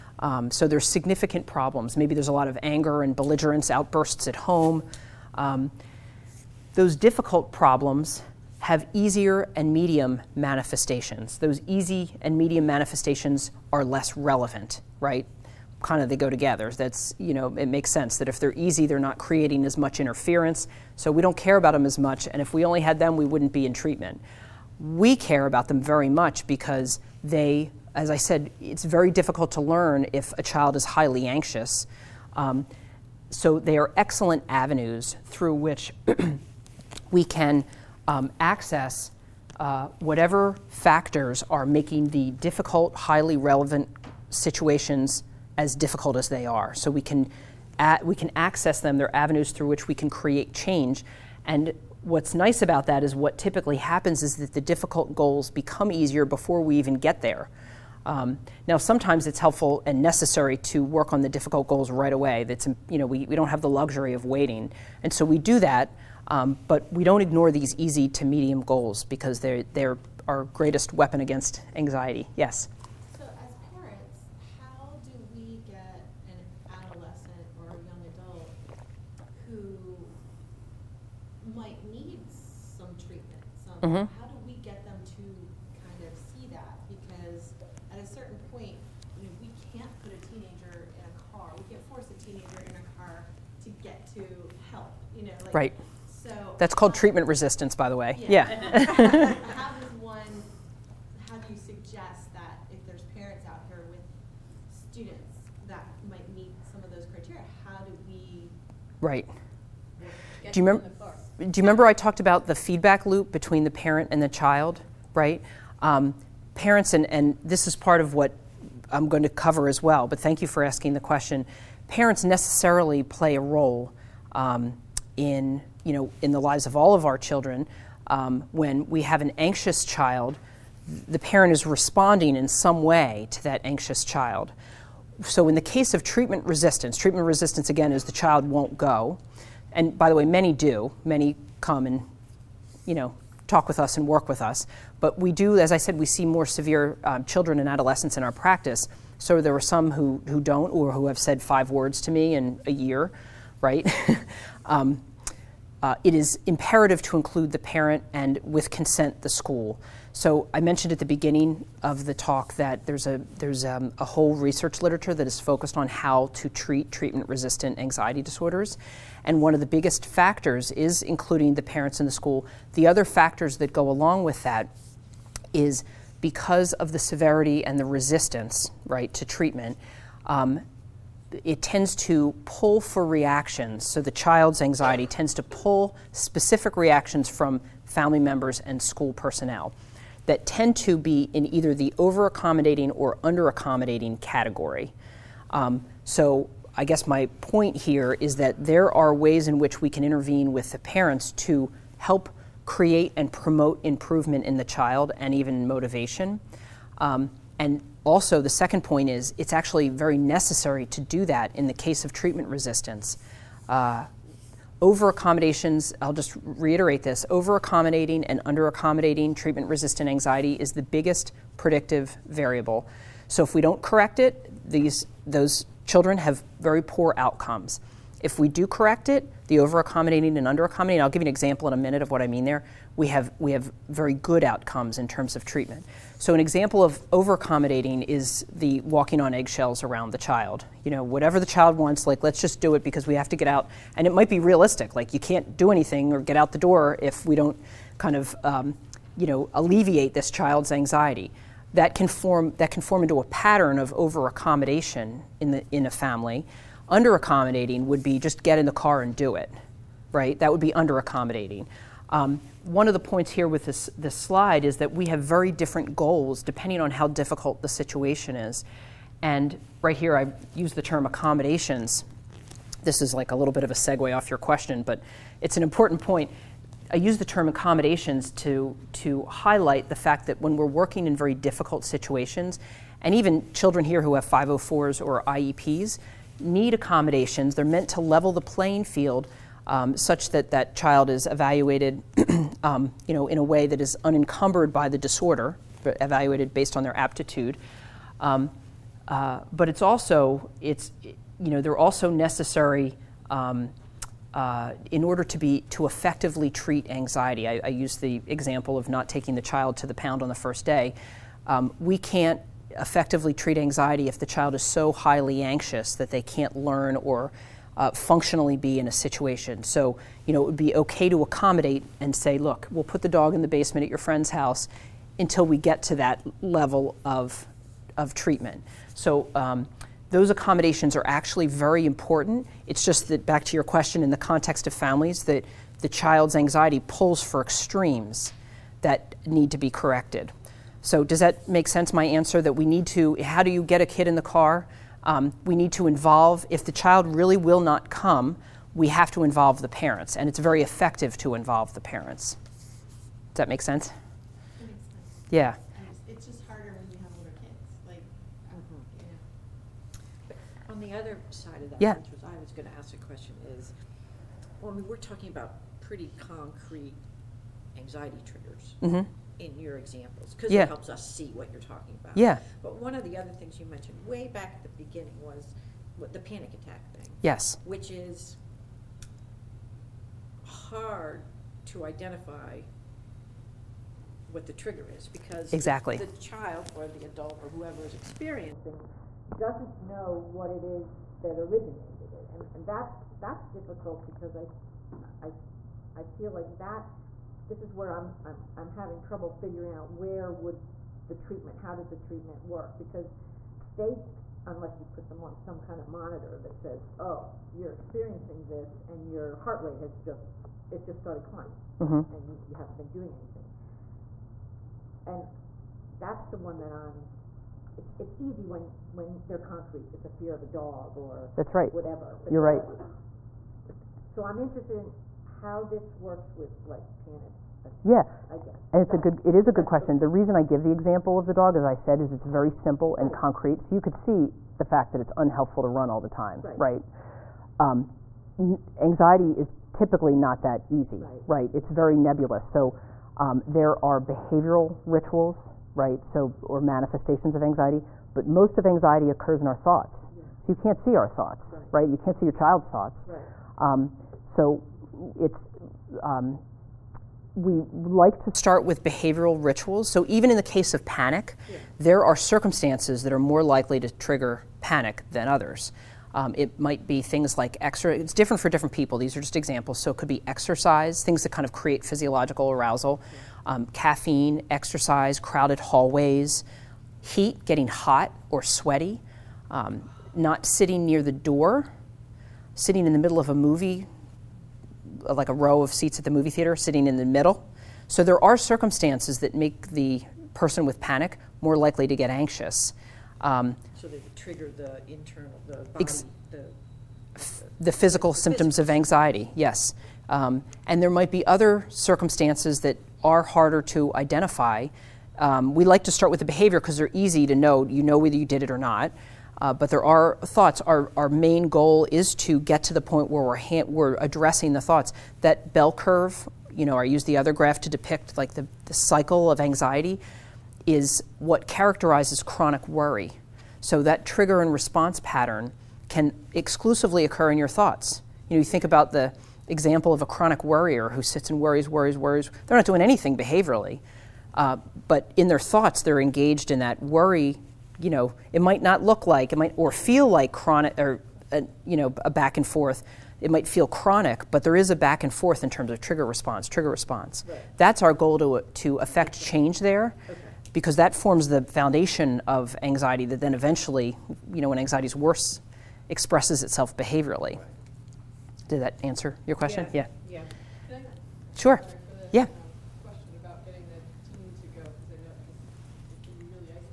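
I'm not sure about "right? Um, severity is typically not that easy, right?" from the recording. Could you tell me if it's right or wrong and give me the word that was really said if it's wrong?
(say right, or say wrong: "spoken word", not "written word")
wrong: "anxiety", not "severity".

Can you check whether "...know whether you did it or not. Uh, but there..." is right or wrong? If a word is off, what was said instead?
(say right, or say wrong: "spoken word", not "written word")
right.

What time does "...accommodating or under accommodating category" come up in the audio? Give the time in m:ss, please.
3:12.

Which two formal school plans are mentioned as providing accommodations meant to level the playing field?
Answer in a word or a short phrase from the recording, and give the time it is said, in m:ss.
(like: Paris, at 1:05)
504s or IEPs, at 4:44.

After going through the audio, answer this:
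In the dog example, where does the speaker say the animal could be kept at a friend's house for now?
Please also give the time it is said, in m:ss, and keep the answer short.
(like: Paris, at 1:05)
the basement, at 5:23.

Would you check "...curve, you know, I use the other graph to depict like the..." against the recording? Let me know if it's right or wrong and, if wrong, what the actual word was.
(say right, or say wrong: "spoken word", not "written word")
right.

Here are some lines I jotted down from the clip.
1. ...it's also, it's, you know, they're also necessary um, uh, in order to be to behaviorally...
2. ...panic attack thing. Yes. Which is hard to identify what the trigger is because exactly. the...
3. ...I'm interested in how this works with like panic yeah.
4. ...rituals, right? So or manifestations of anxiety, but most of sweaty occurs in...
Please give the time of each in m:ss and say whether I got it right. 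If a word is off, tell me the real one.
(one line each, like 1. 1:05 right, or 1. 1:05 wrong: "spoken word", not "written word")
1. 4:59 wrong: "effectively", not "behaviorally"
2. 6:16 right
3. 7:04 right
4. 7:24 wrong: "anxiety", not "sweaty".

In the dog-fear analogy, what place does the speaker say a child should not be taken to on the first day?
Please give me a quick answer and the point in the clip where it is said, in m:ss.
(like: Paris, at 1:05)
the pound, at 5:09.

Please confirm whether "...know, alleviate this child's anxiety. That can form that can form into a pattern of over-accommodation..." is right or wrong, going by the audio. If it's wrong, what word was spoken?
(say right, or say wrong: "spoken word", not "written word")
right.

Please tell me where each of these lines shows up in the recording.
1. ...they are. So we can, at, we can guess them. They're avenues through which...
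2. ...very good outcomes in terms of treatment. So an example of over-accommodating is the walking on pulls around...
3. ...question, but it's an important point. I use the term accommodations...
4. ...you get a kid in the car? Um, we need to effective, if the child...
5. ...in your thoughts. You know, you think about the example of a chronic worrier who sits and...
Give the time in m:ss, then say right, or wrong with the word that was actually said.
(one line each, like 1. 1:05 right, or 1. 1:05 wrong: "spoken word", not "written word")
1. 0:46 wrong: "access", not "guess"
2. 3:53 wrong: "eggshells", not "pulls"
3. 4:34 right
4. 5:43 wrong: "involve", not "effective"
5. 8:47 right.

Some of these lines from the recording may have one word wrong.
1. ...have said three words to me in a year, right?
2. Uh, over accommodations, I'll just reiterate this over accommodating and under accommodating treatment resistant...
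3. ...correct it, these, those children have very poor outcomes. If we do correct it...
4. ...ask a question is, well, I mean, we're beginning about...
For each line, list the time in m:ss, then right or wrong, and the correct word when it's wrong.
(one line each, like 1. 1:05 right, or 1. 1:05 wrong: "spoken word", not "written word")
1. 2:31 wrong: "five", not "three"
2. 3:33 right
3. 3:43 right
4. 6:02 wrong: "talking", not "beginning".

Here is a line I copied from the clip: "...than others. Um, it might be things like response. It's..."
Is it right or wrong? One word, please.
wrong.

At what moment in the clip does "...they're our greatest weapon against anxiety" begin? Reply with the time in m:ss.
1:09.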